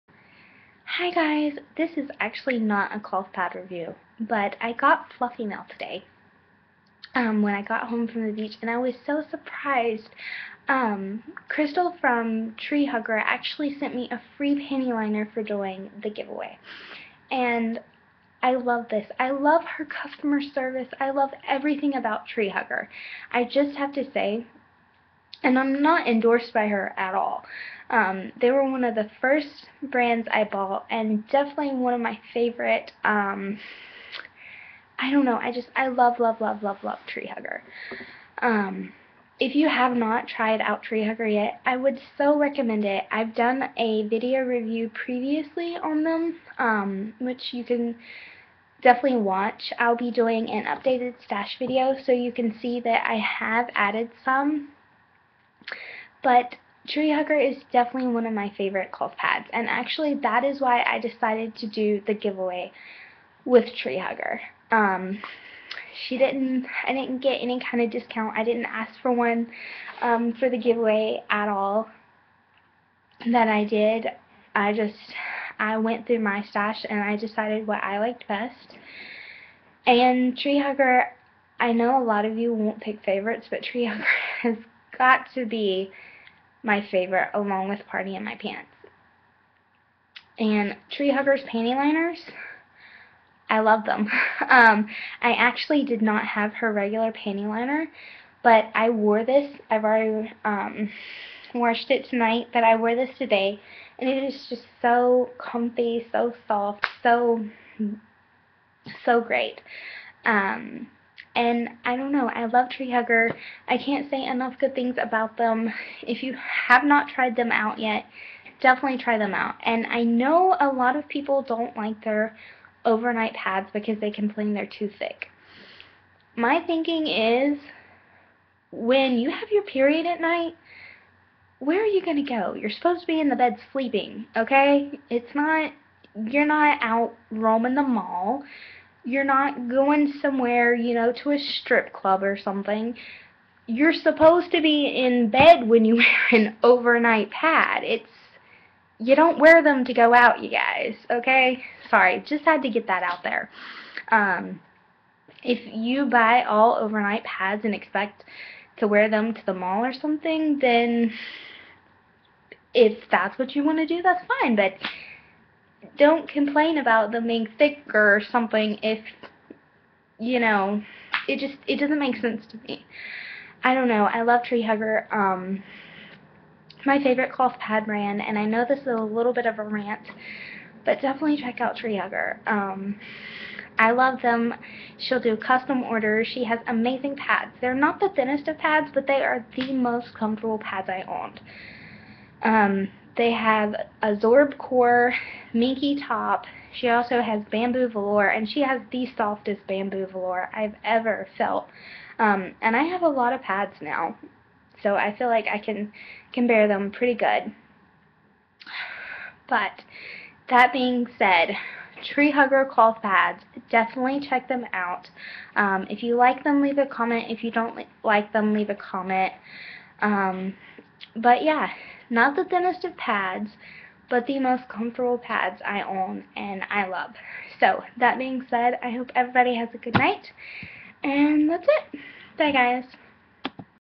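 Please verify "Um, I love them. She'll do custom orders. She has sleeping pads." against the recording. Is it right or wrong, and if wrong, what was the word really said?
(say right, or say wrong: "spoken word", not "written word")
wrong: "amazing", not "sleeping".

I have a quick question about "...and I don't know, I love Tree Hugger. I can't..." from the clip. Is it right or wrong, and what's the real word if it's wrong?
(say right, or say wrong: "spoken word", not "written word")
right.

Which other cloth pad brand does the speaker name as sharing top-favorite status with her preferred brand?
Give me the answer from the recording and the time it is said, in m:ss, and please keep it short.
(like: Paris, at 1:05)
Party in My Pants, at 1:27.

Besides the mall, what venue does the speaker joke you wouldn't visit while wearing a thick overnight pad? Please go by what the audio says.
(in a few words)
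strip club.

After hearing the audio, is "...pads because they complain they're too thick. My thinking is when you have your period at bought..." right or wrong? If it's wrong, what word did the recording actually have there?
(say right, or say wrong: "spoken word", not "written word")
wrong: "night", not "bought".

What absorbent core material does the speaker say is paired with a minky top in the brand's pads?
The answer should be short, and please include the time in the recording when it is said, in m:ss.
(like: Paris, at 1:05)
Zorb, at 3:14.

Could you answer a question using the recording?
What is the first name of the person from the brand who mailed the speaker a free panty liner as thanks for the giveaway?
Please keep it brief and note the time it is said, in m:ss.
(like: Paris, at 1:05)
Crystal, at 0:11.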